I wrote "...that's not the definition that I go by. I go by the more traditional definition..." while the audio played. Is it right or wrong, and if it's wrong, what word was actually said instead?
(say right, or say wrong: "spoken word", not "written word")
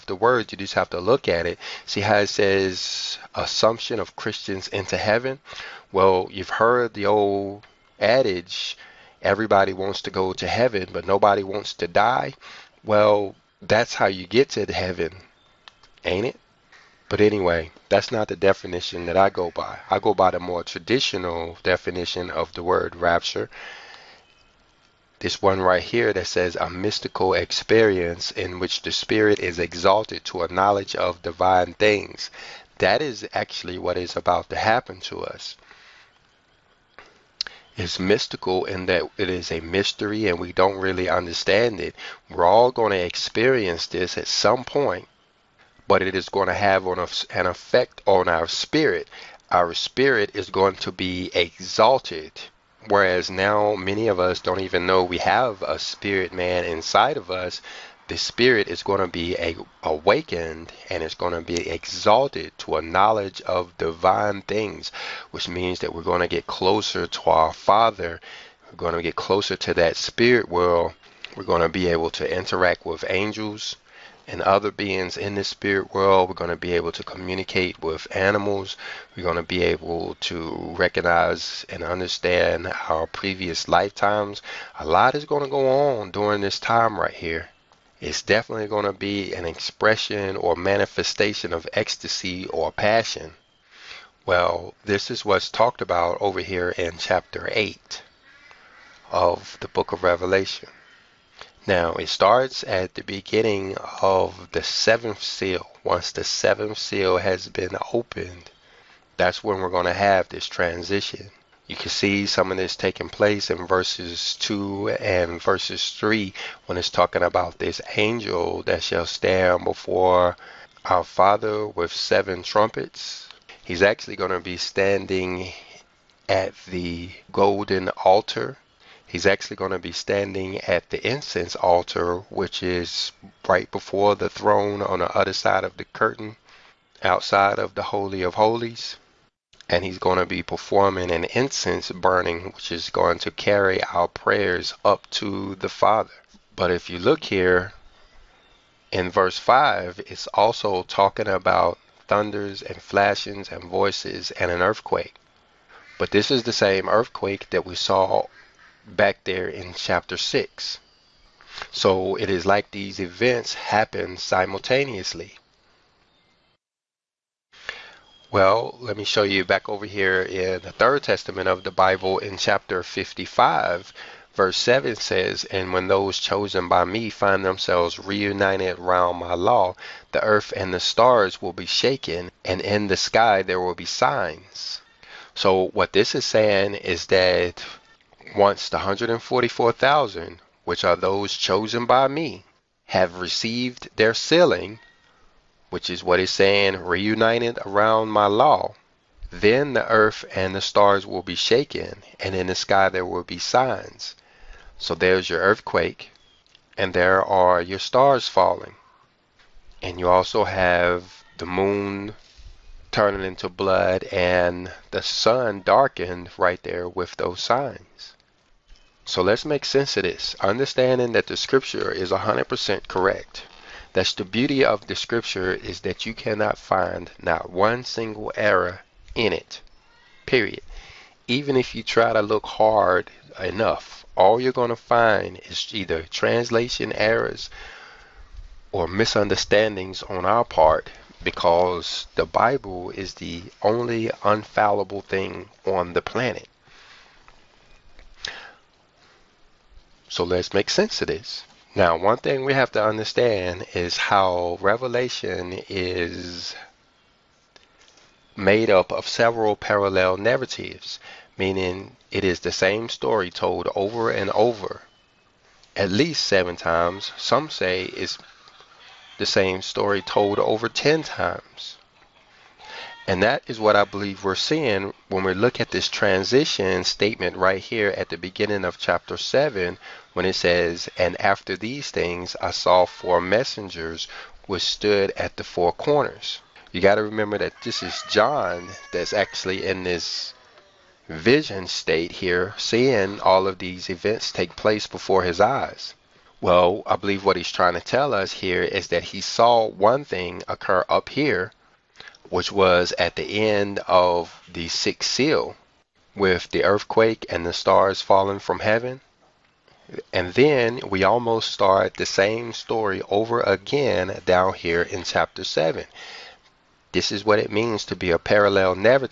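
right.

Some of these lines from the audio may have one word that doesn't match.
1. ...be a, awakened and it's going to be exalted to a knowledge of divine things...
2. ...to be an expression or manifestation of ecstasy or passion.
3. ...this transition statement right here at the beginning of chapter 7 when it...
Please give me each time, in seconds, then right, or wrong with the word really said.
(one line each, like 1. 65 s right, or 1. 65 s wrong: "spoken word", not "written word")
1. 59 s right
2. 88 s right
3. 275 s right.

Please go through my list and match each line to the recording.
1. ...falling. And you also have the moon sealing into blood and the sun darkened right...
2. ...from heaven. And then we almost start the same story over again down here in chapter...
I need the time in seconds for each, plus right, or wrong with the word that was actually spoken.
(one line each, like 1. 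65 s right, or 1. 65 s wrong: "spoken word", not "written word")
1. 208 s wrong: "turning", not "sealing"
2. 308 s right.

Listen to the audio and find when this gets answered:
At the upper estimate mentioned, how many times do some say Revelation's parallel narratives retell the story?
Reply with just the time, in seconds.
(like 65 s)
270 s.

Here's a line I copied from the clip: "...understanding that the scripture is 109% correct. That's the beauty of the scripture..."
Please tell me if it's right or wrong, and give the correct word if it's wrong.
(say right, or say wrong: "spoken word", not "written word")
wrong: "100", not "109".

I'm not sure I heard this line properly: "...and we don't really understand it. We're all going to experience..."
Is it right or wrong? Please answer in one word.
right.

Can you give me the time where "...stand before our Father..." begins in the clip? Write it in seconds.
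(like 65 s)
119 s.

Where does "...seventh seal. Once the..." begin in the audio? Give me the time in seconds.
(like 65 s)
104 s.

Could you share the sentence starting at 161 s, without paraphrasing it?
So it is like these events happen simultaneously.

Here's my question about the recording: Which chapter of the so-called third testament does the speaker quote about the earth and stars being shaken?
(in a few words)
55.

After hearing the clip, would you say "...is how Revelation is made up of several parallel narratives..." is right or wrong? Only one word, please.
right.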